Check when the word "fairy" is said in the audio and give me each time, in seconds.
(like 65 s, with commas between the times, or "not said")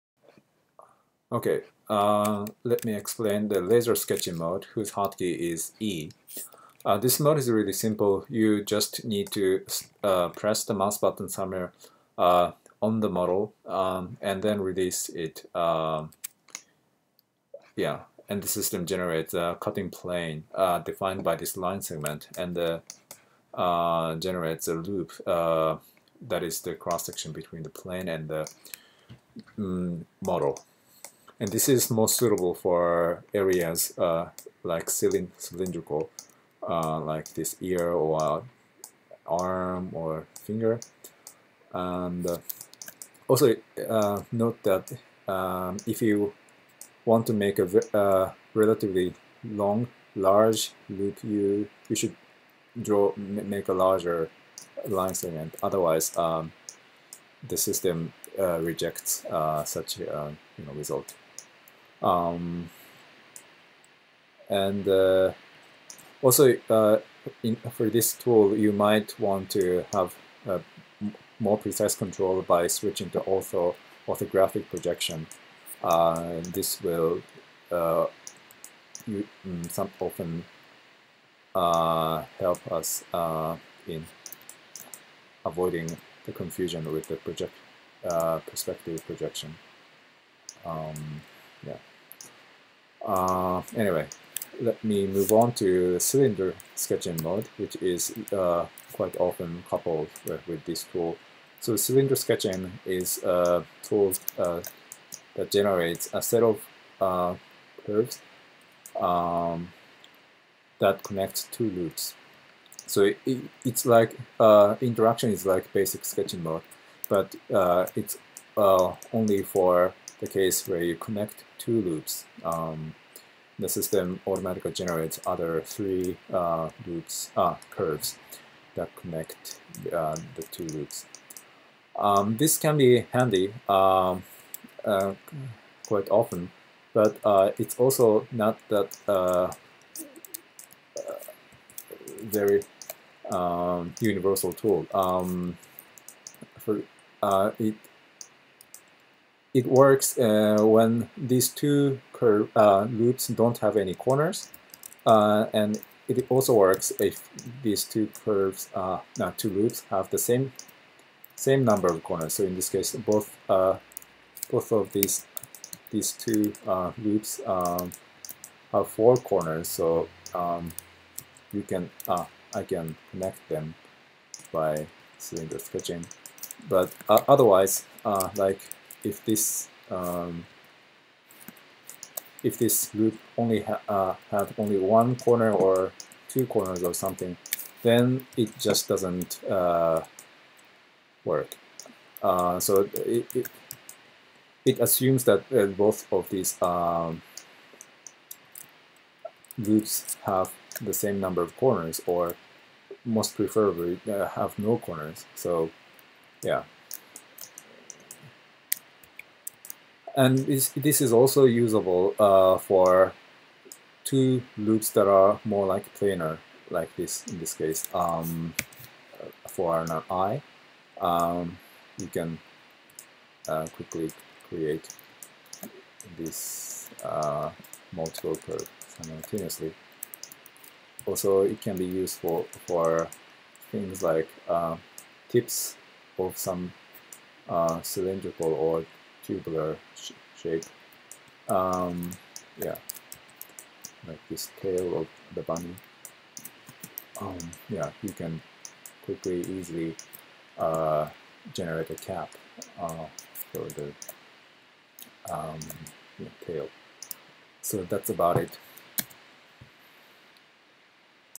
not said.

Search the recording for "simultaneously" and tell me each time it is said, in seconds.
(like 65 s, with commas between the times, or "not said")
228 s.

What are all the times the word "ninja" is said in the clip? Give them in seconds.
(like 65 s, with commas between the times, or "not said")
not said.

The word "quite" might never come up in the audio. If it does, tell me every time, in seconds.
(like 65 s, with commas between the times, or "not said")
98 s, 135 s.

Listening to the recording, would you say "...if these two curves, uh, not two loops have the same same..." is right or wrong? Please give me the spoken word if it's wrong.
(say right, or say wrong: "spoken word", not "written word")
right.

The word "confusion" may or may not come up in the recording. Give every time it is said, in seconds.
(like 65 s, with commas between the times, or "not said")
86 s.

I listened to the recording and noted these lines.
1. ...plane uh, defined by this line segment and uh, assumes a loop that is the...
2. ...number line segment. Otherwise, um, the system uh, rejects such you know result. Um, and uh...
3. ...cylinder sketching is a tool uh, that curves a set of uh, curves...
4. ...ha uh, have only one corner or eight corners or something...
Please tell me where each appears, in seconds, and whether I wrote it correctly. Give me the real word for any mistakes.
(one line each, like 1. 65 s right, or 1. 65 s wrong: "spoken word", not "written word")
1. 19 s wrong: "generates", not "assumes"
2. 53 s wrong: "larger", not "number"
3. 101 s wrong: "generates", not "curves"
4. 183 s wrong: "two", not "eight".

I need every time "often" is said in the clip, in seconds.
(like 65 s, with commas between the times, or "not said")
79 s, 99 s, 136 s.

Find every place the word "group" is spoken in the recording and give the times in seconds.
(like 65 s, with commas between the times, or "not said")
182 s, 199 s.